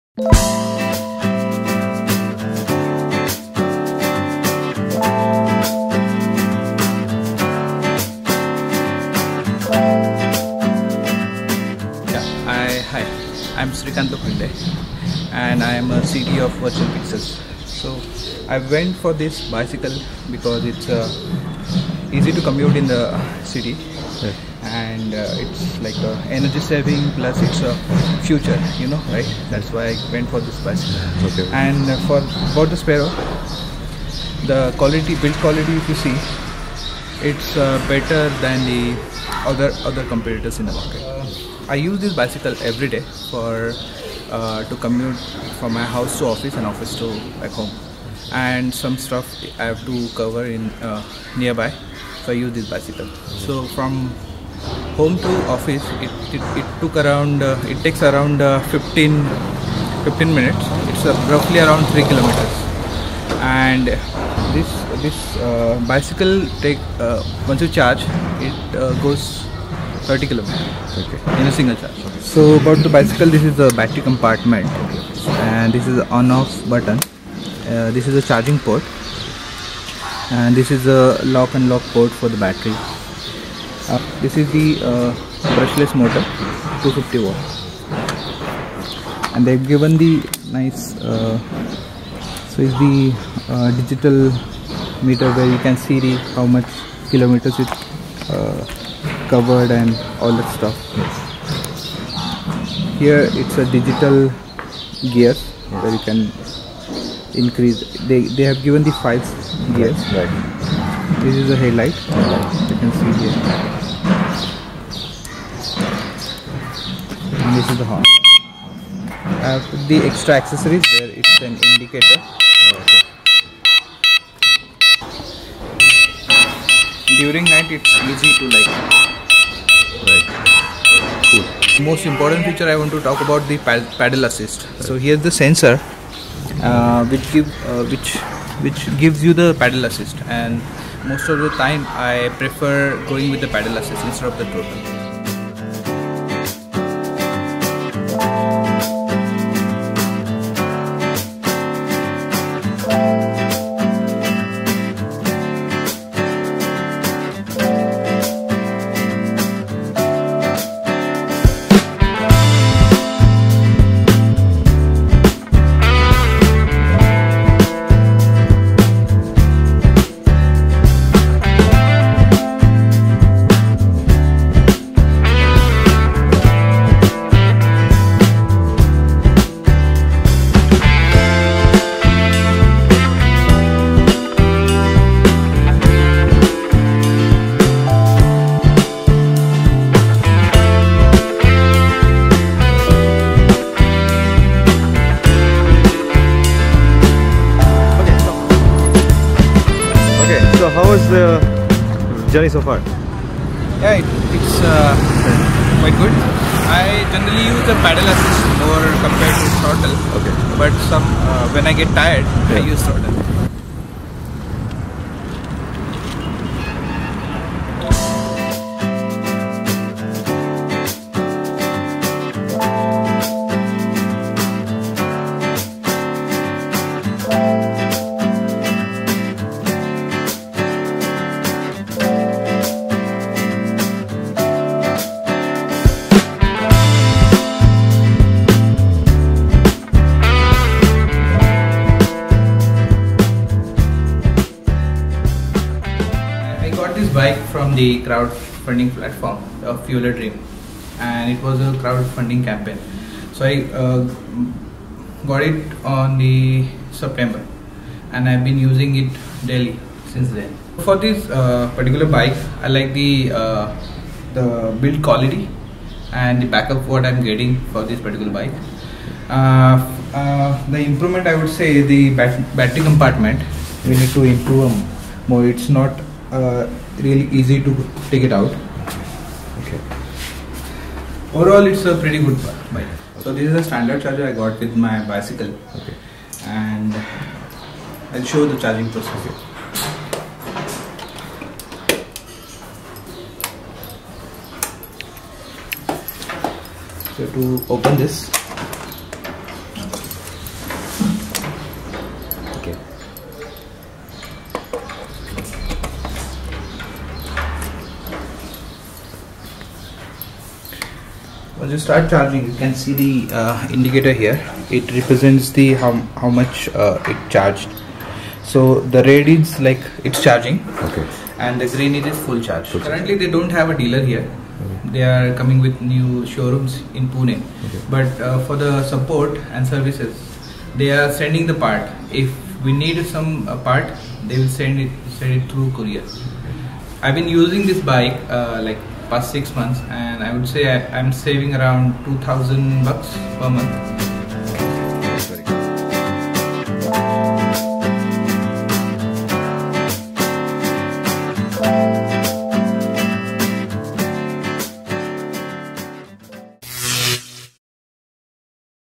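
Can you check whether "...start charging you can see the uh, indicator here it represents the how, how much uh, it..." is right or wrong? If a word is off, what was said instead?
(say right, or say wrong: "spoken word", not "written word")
right.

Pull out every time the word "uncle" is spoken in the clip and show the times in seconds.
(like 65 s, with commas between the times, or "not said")
not said.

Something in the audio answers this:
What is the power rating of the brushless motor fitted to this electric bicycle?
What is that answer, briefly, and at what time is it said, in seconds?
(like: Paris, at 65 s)
250 watt, at 86 s.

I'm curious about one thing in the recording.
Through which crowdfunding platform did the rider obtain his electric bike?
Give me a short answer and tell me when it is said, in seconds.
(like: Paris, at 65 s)
Fueladream, at 249 s.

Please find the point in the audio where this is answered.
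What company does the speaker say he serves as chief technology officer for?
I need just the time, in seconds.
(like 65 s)
16 s.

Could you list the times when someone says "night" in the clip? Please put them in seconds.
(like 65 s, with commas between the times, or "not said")
127 s.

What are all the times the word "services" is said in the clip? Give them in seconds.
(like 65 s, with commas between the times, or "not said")
329 s.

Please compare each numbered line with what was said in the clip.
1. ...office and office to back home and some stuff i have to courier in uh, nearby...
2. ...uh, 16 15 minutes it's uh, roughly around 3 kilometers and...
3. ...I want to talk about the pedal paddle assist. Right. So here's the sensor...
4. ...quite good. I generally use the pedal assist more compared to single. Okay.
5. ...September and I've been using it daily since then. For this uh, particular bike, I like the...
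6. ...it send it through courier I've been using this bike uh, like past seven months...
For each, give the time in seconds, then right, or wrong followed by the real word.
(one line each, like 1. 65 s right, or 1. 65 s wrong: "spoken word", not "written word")
1. 46 s wrong: "cover", not "courier"
2. 58 s wrong: "15", not "16"
3. 132 s right
4. 205 s wrong: "throttle", not "single"
5. 256 s right
6. 334 s wrong: "six", not "seven".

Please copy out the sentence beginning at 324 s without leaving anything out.
they are coming with new showrooms in Pune okay.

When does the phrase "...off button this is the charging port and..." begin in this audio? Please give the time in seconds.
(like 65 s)
76 s.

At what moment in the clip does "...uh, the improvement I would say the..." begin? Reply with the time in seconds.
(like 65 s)
270 s.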